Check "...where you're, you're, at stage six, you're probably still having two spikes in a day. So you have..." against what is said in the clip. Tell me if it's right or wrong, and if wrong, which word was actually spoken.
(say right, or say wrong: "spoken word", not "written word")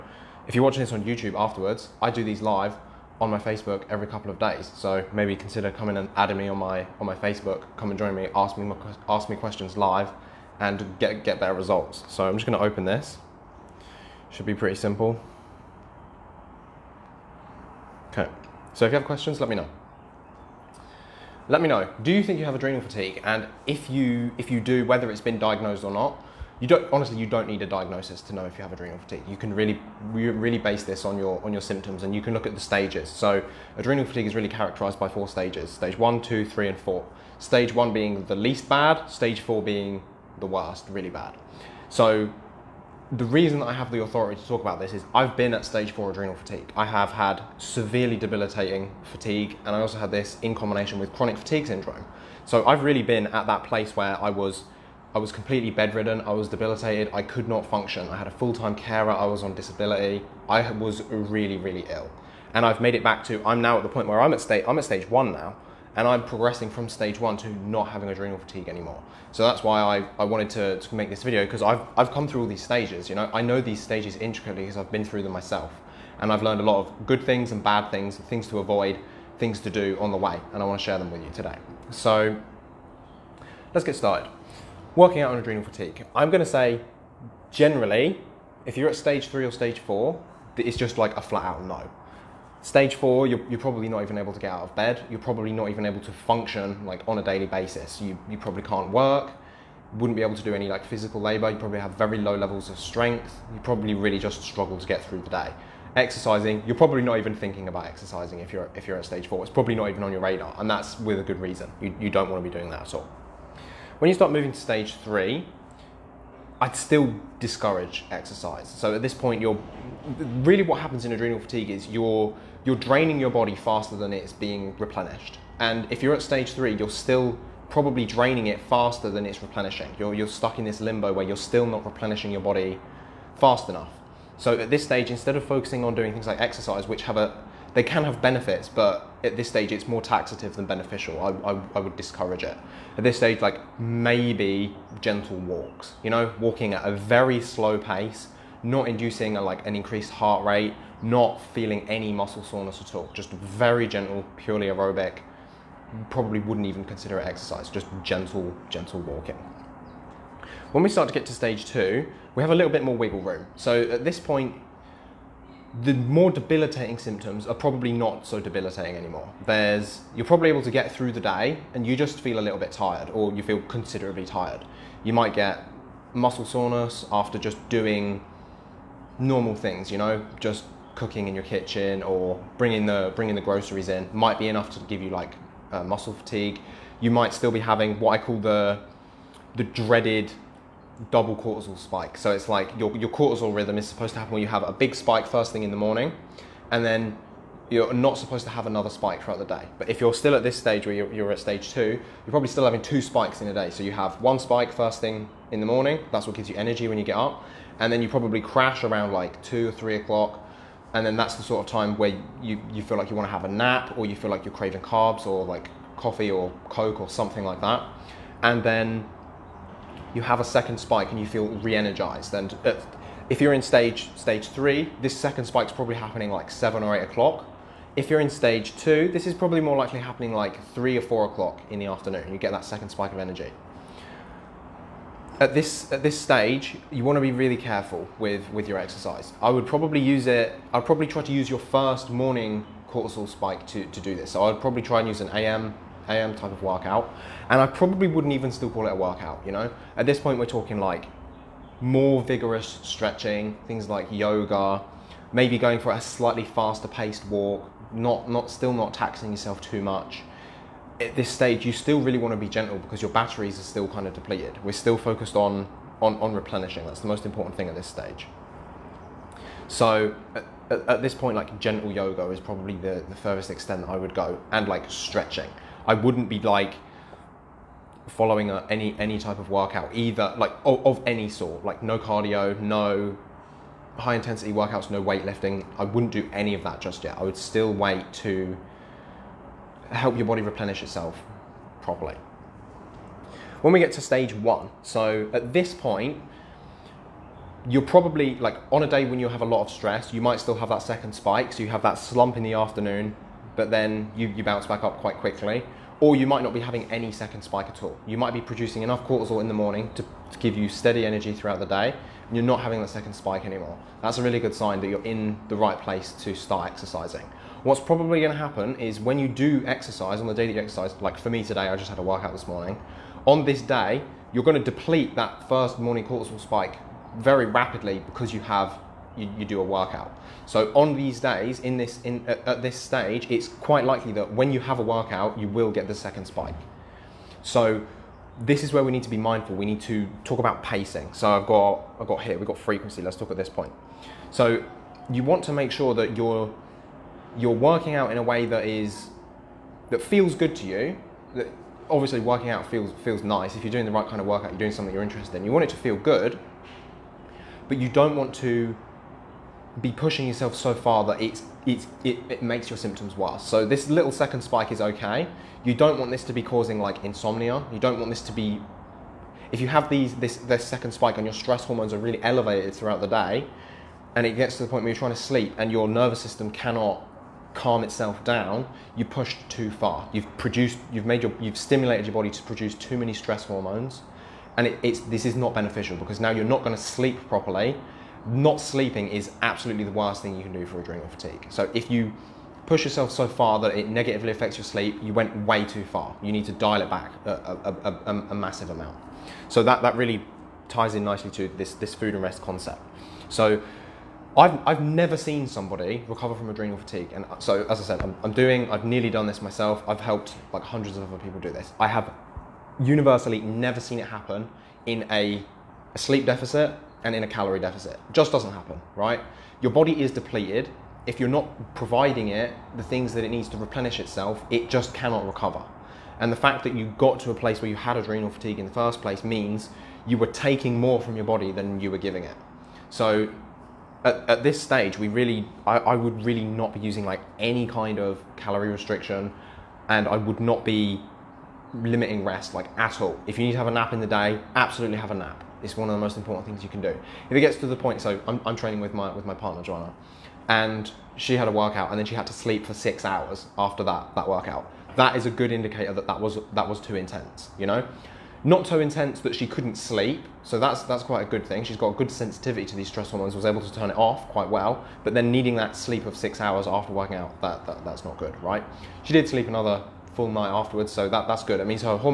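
wrong: "two", not "six".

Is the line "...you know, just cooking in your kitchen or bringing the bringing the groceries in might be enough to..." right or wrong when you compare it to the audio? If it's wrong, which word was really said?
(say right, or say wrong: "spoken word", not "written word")
right.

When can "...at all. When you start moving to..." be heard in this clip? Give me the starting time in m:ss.
1:52.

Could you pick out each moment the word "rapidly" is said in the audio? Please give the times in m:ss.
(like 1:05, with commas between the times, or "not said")
5:27.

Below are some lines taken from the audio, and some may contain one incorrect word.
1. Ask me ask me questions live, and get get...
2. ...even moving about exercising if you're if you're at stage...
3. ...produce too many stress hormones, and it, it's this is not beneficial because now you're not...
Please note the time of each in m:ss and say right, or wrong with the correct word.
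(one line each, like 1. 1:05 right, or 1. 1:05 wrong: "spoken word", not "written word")
1. 0:08 right
2. 1:47 wrong: "thinking", not "moving"
3. 6:22 right.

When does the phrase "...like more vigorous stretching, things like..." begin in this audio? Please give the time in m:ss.
4:10.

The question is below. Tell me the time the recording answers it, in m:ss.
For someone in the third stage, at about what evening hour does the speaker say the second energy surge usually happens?
3:46.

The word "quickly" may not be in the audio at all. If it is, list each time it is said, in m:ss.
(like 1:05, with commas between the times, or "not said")
5:05.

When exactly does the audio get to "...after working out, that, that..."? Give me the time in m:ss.
7:46.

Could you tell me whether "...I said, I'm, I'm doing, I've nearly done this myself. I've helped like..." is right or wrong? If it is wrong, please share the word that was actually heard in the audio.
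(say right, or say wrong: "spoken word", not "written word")
right.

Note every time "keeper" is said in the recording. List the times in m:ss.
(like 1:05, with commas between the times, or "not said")
not said.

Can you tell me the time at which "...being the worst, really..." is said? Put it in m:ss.
0:39.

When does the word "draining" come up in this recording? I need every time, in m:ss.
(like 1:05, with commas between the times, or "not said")
2:02, 2:08.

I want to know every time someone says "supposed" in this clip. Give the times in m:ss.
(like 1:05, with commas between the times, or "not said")
3:13, 3:18.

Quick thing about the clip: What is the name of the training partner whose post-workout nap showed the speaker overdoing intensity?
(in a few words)
Joanna.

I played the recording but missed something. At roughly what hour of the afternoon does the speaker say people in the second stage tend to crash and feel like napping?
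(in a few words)
2 or 3 o'clock.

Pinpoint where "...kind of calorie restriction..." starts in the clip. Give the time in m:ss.
7:17.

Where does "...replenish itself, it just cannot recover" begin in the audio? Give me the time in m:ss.
7:03.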